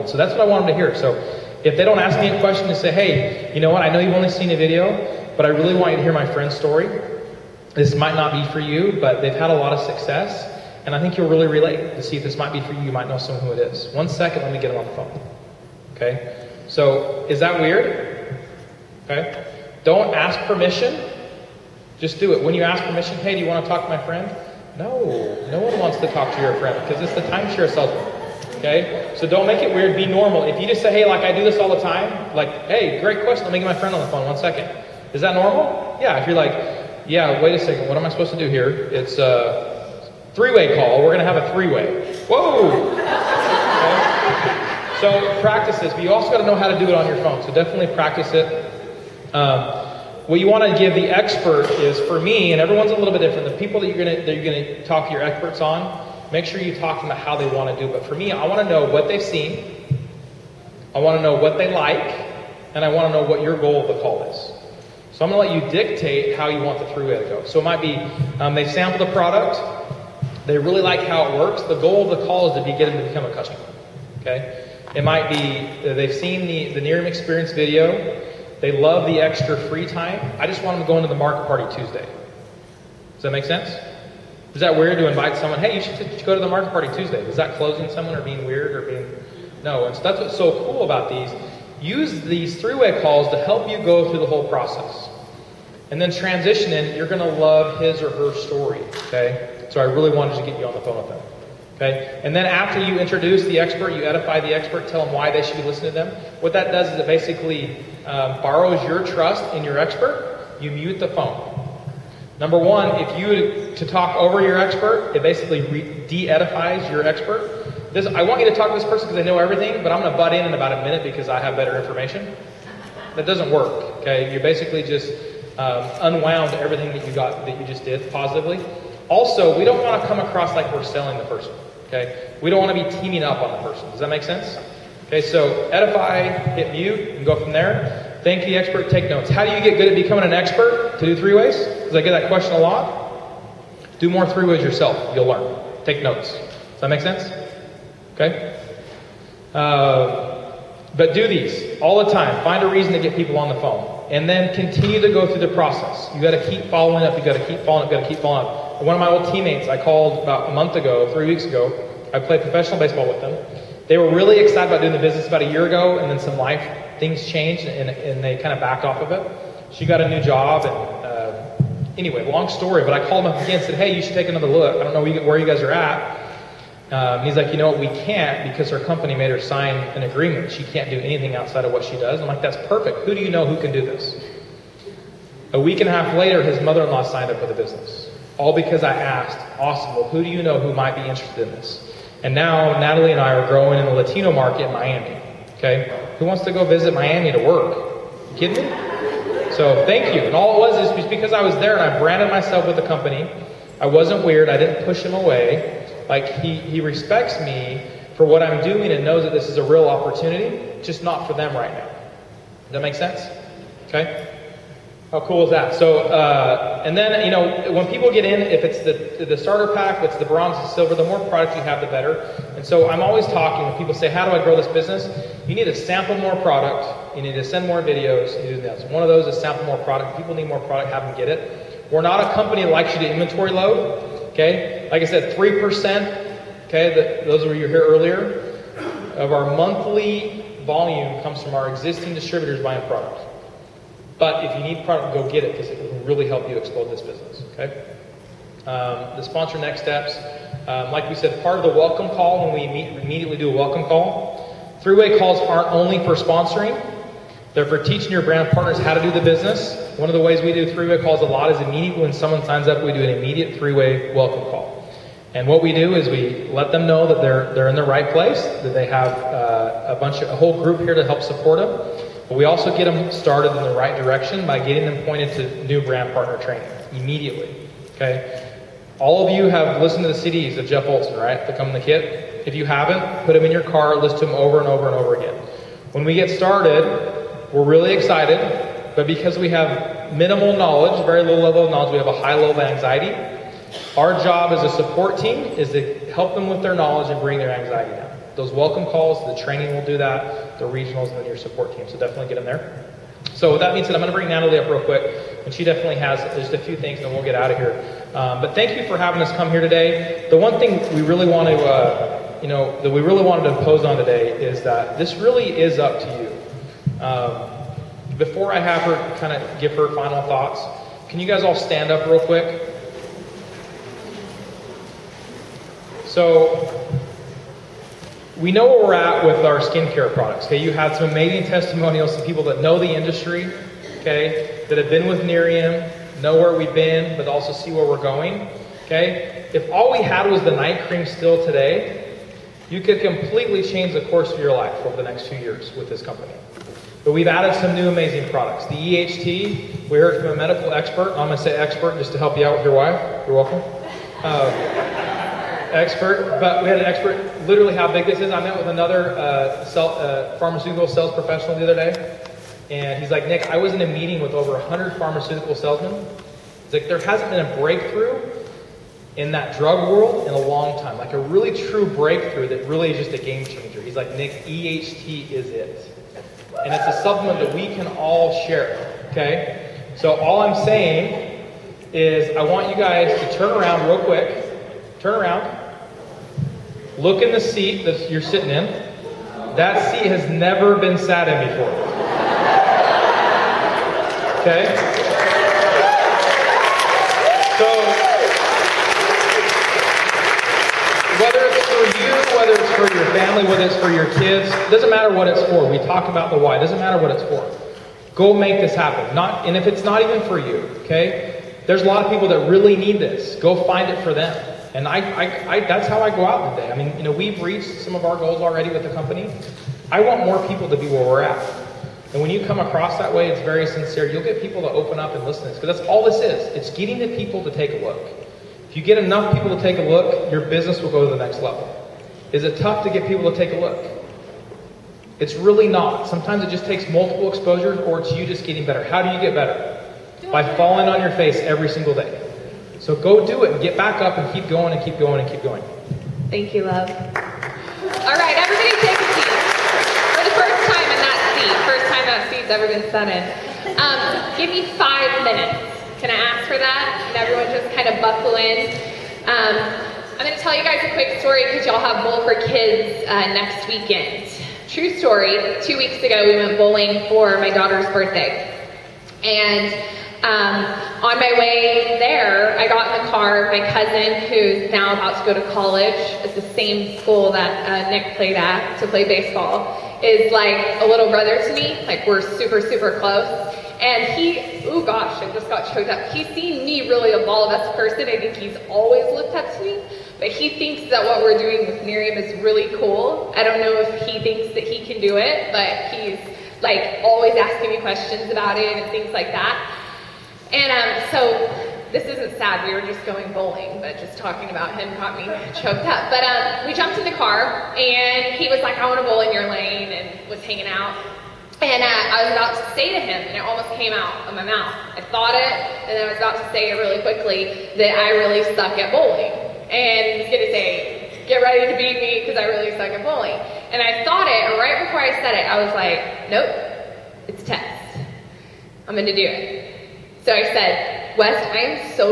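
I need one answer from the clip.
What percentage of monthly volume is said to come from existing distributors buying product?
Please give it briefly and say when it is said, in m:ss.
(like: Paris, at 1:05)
3%, at 3:55.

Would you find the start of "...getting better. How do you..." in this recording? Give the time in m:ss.
7:18.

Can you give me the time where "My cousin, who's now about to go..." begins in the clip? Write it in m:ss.
7:53.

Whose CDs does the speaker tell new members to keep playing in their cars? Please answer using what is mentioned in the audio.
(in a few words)
Jeff Olson.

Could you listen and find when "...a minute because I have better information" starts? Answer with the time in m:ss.
2:00.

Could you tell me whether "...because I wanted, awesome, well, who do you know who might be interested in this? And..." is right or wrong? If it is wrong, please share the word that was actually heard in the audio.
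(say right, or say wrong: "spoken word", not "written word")
wrong: "asked", not "wanted".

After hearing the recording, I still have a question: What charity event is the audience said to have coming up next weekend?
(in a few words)
Bowl for Kids.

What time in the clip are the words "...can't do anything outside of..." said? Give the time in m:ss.
3:00.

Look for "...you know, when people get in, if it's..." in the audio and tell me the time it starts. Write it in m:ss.
3:37.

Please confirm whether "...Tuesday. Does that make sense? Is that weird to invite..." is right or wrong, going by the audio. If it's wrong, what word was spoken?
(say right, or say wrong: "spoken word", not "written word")
right.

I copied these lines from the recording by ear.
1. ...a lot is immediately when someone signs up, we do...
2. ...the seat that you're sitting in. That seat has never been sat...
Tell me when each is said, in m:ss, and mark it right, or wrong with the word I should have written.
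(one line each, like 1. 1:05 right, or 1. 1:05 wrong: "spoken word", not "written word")
1. 4:21 right
2. 6:27 right.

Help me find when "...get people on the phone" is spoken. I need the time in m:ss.
2:32.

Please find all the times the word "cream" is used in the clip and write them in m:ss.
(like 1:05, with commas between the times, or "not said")
5:40.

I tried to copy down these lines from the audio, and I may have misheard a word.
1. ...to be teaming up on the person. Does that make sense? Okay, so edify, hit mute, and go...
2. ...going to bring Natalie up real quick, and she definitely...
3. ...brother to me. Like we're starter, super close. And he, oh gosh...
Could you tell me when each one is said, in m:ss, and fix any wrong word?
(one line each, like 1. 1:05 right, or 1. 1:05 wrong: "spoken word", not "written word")
1. 2:12 right
2. 5:04 right
3. 8:01 wrong: "super", not "starter".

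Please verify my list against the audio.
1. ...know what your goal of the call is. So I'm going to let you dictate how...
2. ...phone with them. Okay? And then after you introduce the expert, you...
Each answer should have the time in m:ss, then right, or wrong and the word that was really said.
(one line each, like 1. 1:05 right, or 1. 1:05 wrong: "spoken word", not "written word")
1. 1:03 right
2. 1:40 right.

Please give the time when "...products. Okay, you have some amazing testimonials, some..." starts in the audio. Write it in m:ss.
5:30.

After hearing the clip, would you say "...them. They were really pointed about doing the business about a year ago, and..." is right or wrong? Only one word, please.
wrong.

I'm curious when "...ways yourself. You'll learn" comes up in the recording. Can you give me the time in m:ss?
2:24.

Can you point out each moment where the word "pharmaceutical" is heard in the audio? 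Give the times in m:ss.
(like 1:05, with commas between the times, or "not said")
6:00, 6:04.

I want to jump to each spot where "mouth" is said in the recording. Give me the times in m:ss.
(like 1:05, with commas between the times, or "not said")
8:34.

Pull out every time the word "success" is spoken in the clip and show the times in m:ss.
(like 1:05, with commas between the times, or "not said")
0:09.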